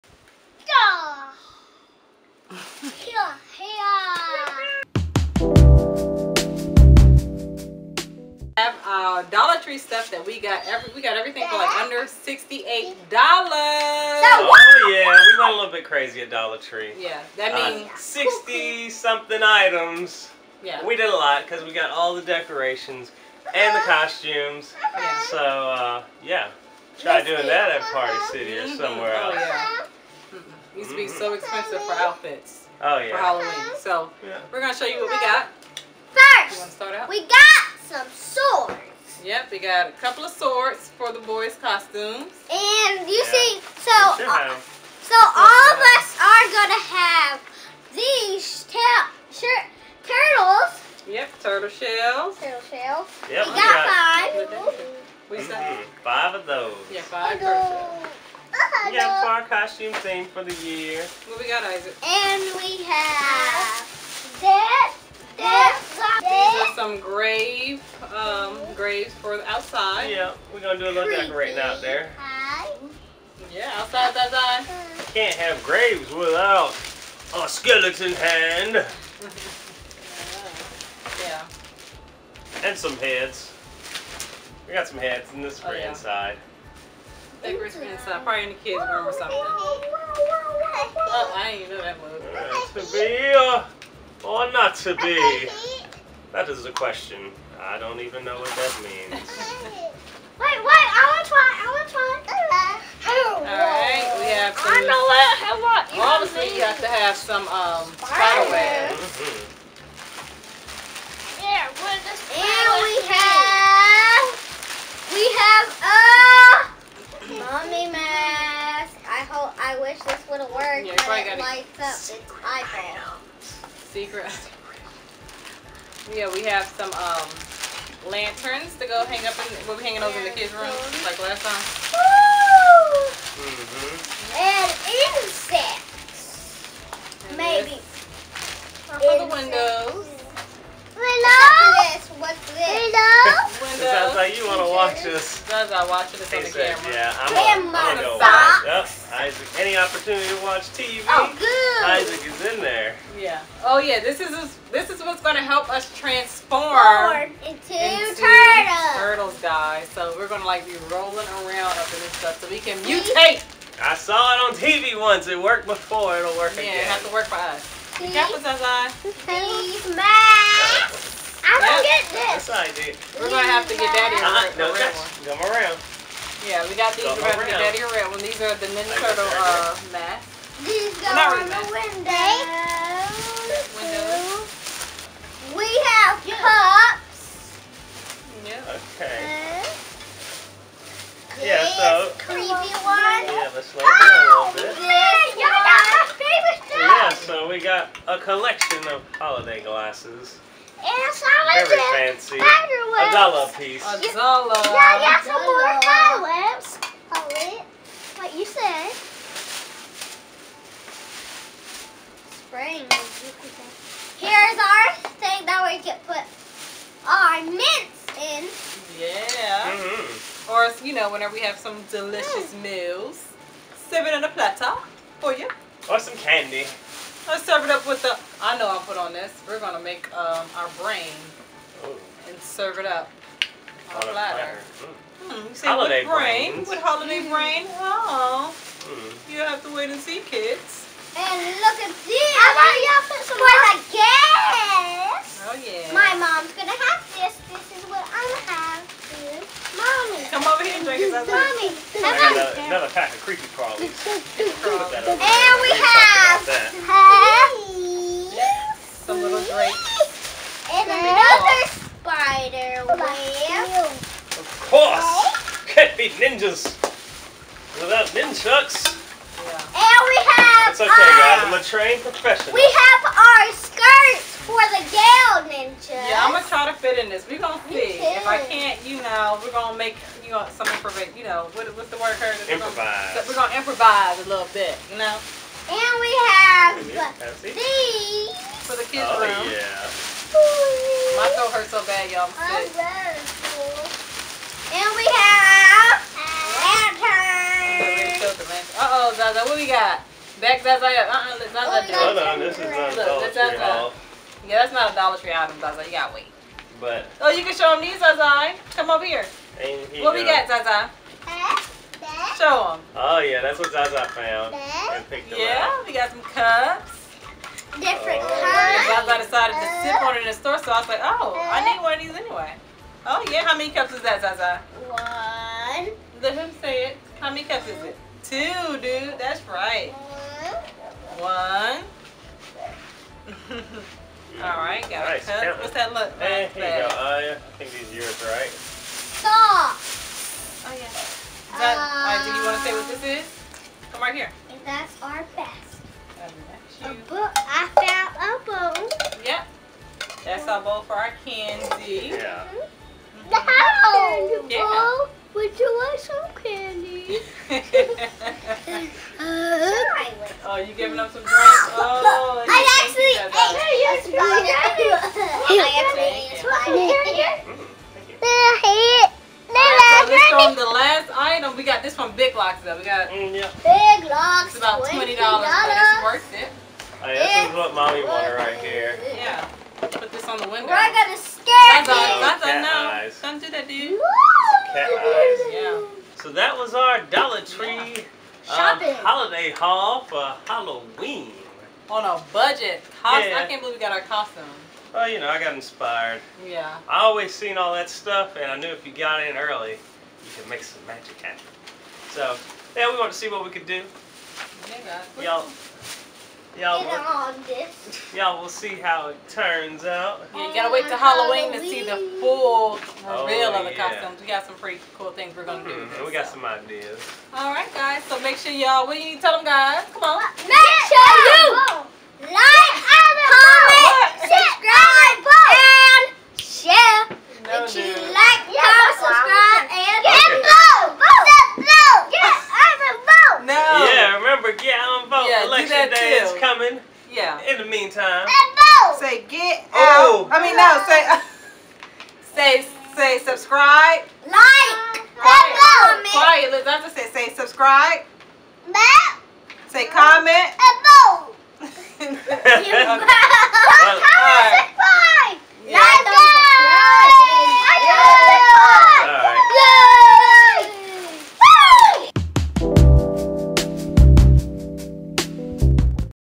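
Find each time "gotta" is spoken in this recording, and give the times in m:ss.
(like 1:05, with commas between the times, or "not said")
5:05, 6:50.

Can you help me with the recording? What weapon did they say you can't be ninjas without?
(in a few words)
nunchucks.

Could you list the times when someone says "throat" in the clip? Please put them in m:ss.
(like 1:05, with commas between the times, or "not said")
4:51.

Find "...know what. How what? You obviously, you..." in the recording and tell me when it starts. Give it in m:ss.
1:44.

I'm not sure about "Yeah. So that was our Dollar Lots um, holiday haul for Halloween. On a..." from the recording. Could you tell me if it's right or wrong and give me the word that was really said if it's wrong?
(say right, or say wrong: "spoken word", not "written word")
wrong: "Tree", not "Lots".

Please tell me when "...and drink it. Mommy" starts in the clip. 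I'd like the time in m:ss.
4:10.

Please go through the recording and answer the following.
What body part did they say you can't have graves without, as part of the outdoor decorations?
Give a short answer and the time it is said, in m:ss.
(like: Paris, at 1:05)
skeleton hand, at 1:17.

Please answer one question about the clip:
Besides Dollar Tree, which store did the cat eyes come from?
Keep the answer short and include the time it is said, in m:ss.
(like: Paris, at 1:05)
Big Lots, at 6:12.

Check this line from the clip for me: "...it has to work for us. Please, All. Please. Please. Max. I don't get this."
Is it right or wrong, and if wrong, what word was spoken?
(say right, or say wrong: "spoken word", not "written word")
wrong: "Please", not "All".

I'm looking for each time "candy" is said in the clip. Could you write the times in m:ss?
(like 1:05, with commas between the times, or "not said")
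3:46, 5:51, 5:56.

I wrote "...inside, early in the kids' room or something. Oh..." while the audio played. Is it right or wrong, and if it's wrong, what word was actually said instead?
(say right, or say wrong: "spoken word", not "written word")
wrong: "probably", not "early".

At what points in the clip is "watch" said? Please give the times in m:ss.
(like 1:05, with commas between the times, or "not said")
2:25, 2:30.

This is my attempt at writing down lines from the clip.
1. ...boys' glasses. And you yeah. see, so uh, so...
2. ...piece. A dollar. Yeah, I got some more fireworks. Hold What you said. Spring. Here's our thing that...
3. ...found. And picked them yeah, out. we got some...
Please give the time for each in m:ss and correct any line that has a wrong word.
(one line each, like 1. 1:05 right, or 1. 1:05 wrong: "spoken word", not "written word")
1. 0:41 wrong: "costumes", not "glasses"
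2. 3:23 right
3. 5:14 right.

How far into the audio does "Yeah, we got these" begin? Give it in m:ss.
2:56.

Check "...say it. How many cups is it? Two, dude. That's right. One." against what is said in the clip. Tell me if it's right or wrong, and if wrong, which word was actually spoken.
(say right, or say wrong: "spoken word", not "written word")
right.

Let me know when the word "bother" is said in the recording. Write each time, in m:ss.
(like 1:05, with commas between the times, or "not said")
not said.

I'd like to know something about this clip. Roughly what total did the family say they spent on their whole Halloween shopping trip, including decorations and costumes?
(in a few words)
under $68.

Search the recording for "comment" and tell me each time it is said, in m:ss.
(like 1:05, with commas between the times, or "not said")
7:25, 7:29.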